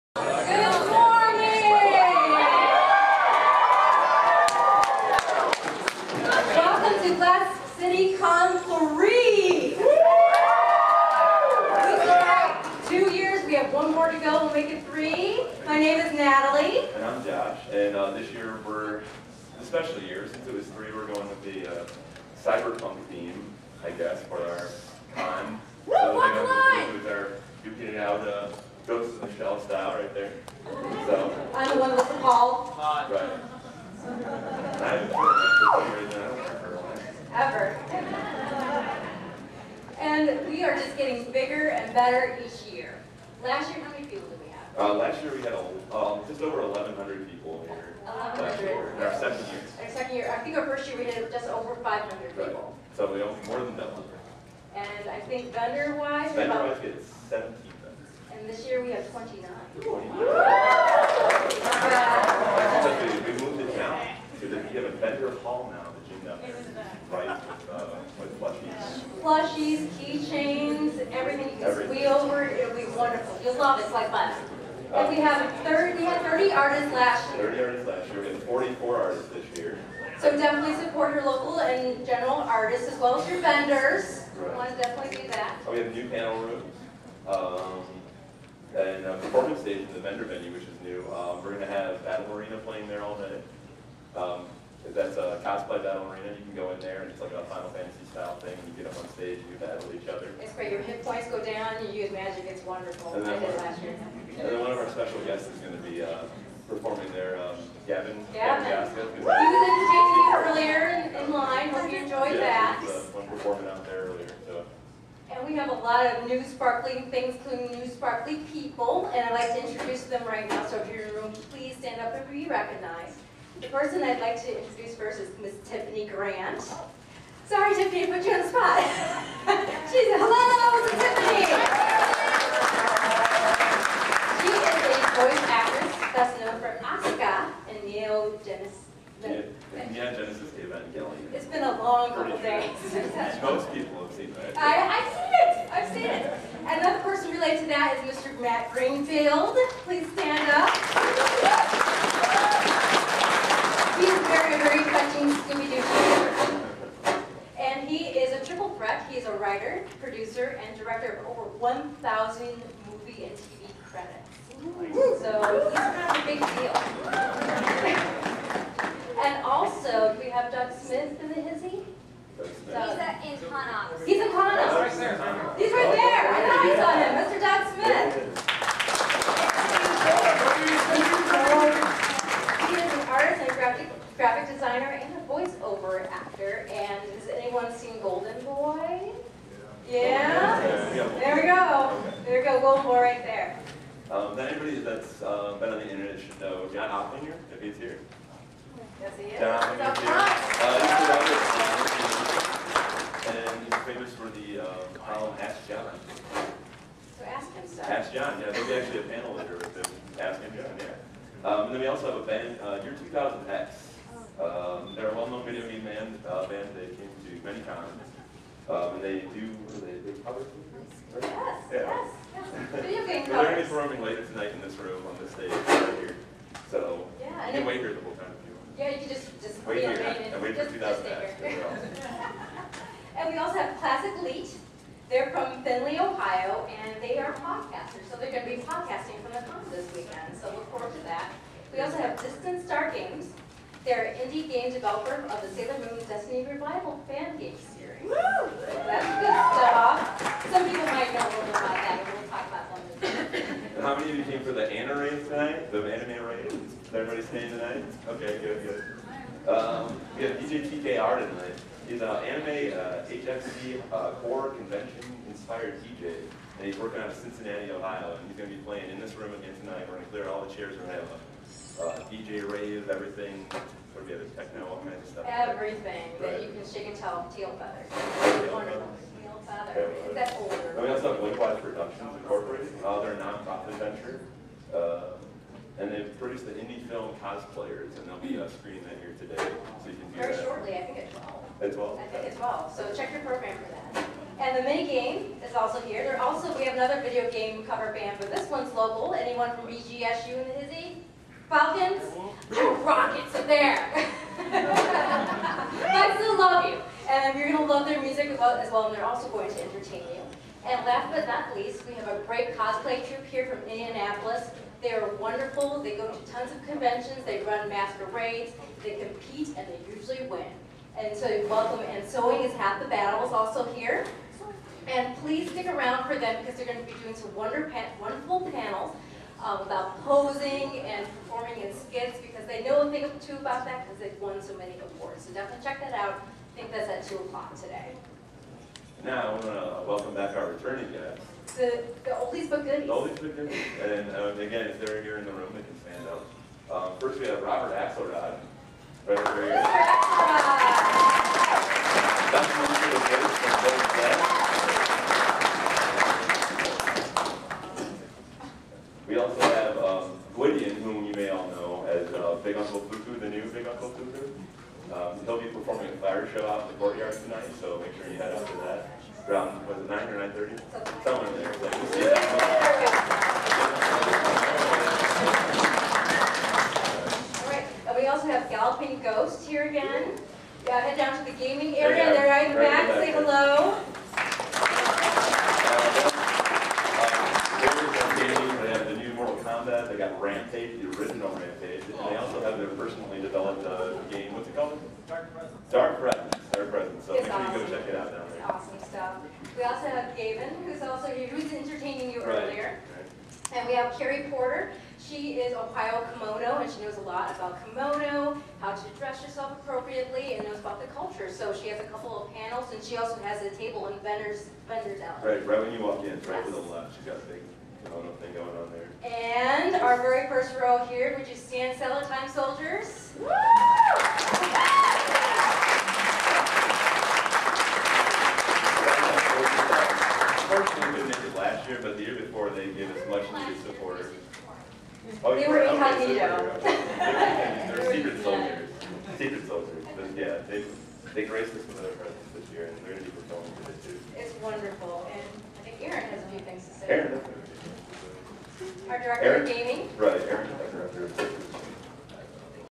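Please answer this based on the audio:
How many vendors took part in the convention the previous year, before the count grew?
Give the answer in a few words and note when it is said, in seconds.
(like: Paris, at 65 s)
17, at 57 s.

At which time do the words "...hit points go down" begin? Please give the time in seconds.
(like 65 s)
100 s.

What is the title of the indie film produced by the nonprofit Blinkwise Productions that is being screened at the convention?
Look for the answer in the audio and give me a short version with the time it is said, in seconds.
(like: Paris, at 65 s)
Cosplayers, at 287 s.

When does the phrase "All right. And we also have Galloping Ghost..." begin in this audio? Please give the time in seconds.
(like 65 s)
377 s.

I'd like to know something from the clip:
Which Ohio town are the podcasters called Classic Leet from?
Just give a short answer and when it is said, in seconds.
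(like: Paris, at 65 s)
Findlay, at 235 s.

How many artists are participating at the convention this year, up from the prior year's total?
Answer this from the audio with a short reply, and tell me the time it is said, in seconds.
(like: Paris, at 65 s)
44, at 78 s.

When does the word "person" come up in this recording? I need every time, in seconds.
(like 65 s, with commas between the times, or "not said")
123 s, 147 s.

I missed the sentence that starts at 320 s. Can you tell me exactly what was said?
And so welcome, and sewing is half the battle is also here.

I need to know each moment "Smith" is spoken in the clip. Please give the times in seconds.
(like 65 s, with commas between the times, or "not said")
170 s.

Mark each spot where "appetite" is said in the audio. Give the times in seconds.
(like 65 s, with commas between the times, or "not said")
not said.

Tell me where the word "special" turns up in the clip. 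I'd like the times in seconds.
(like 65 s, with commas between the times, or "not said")
19 s, 104 s.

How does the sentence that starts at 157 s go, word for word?
And he is a triple threat.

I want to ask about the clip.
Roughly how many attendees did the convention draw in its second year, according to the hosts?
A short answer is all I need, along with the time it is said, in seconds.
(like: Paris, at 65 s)
1,100, at 46 s.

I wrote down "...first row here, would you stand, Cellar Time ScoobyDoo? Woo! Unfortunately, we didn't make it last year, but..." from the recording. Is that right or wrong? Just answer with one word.
wrong.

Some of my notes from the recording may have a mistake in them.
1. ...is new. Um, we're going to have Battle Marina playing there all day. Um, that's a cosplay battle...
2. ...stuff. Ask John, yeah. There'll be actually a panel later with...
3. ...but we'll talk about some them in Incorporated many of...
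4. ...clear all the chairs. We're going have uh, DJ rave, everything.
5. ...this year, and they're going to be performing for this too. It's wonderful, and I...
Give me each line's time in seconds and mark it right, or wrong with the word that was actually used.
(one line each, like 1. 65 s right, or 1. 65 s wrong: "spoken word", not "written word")
1. 90 s right
2. 207 s right
3. 252 s wrong: "How", not "Incorporated"
4. 270 s right
5. 442 s right.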